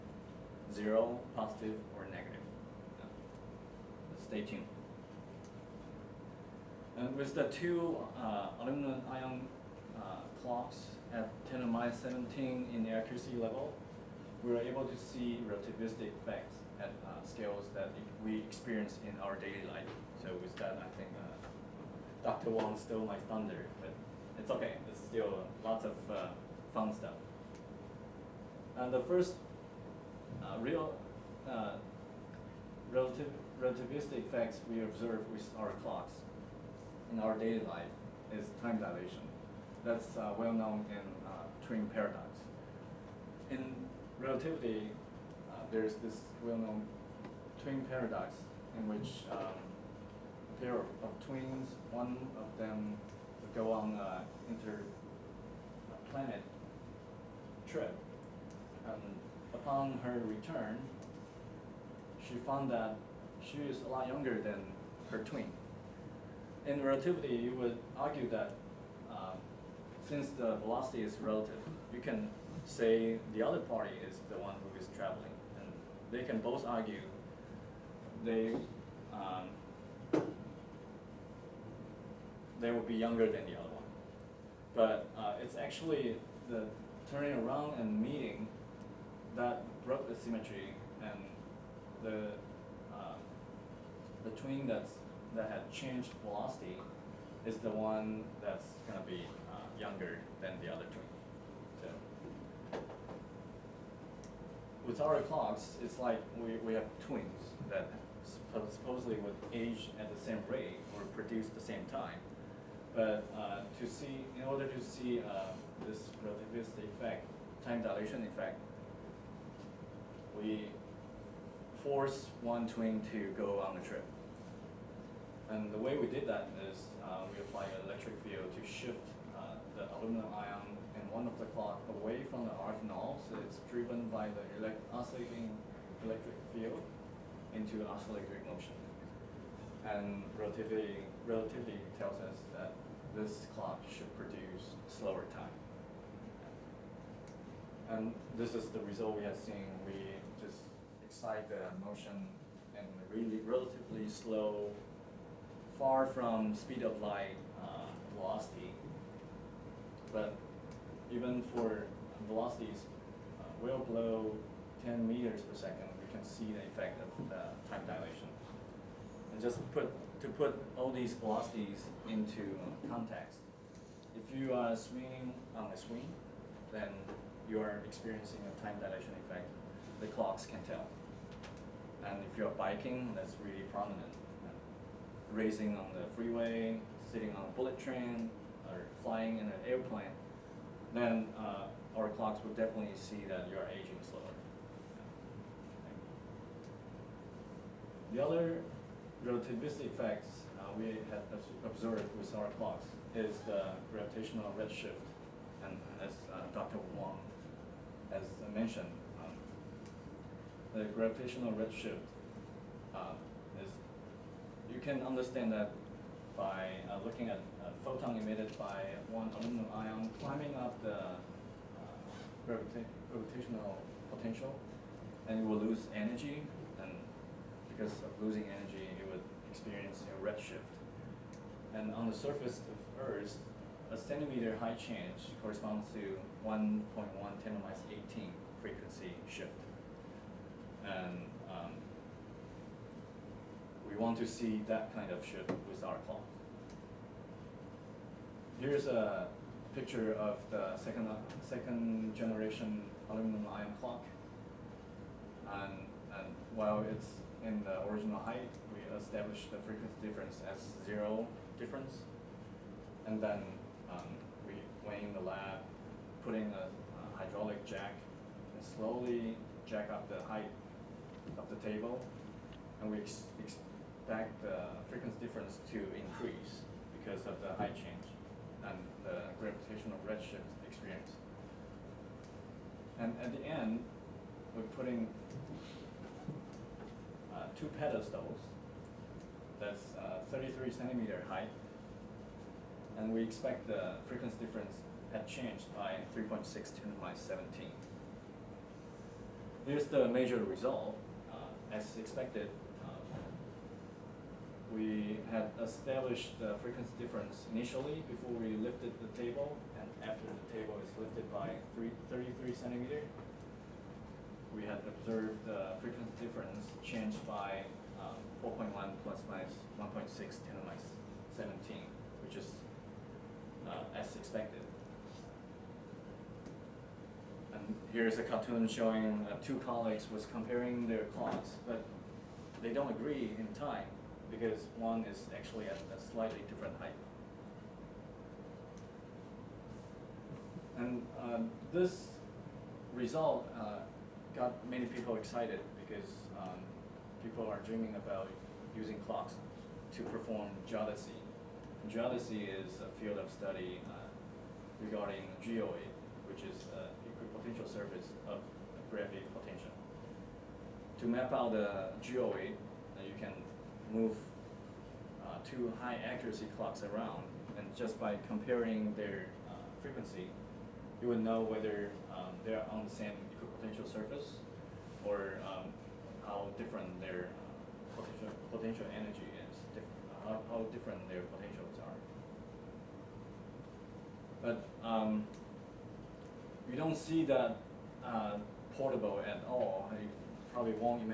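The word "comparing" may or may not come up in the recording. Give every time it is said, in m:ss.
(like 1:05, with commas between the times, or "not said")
5:30, 6:08.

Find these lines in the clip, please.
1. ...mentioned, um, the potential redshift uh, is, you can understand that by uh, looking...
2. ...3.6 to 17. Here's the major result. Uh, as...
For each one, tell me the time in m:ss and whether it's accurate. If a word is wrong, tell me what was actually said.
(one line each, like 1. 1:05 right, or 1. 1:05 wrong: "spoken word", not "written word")
1. 3:28 wrong: "gravitational", not "potential"
2. 4:56 right.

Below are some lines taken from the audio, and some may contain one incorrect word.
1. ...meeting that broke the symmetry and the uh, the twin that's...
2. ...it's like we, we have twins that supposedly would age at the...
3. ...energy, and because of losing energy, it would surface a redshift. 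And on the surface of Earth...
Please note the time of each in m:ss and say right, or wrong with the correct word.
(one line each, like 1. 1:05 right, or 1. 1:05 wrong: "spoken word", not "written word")
1. 1:27 right
2. 1:45 right
3. 3:45 wrong: "experience", not "surface".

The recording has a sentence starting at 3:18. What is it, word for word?
The other relativistic effects uh, we have observed with our clocks is the gravitational redshift.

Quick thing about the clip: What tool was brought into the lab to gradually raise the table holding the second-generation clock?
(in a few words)
hydraulic jack.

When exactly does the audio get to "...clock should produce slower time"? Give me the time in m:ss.
2:23.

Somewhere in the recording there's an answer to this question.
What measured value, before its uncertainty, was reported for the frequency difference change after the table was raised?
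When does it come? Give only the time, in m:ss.
5:18.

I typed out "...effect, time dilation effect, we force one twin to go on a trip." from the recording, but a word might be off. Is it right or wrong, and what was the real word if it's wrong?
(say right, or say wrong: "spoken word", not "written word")
right.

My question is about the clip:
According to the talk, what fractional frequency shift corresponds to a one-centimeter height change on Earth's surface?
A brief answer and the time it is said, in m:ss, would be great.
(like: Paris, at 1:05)
1.1 x 10^-18, at 3:56.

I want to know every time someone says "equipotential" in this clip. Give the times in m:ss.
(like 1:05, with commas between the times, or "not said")
5:57, 6:13.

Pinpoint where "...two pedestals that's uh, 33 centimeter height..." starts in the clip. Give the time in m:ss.
4:47.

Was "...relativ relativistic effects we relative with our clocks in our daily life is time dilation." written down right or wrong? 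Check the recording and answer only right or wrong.
wrong.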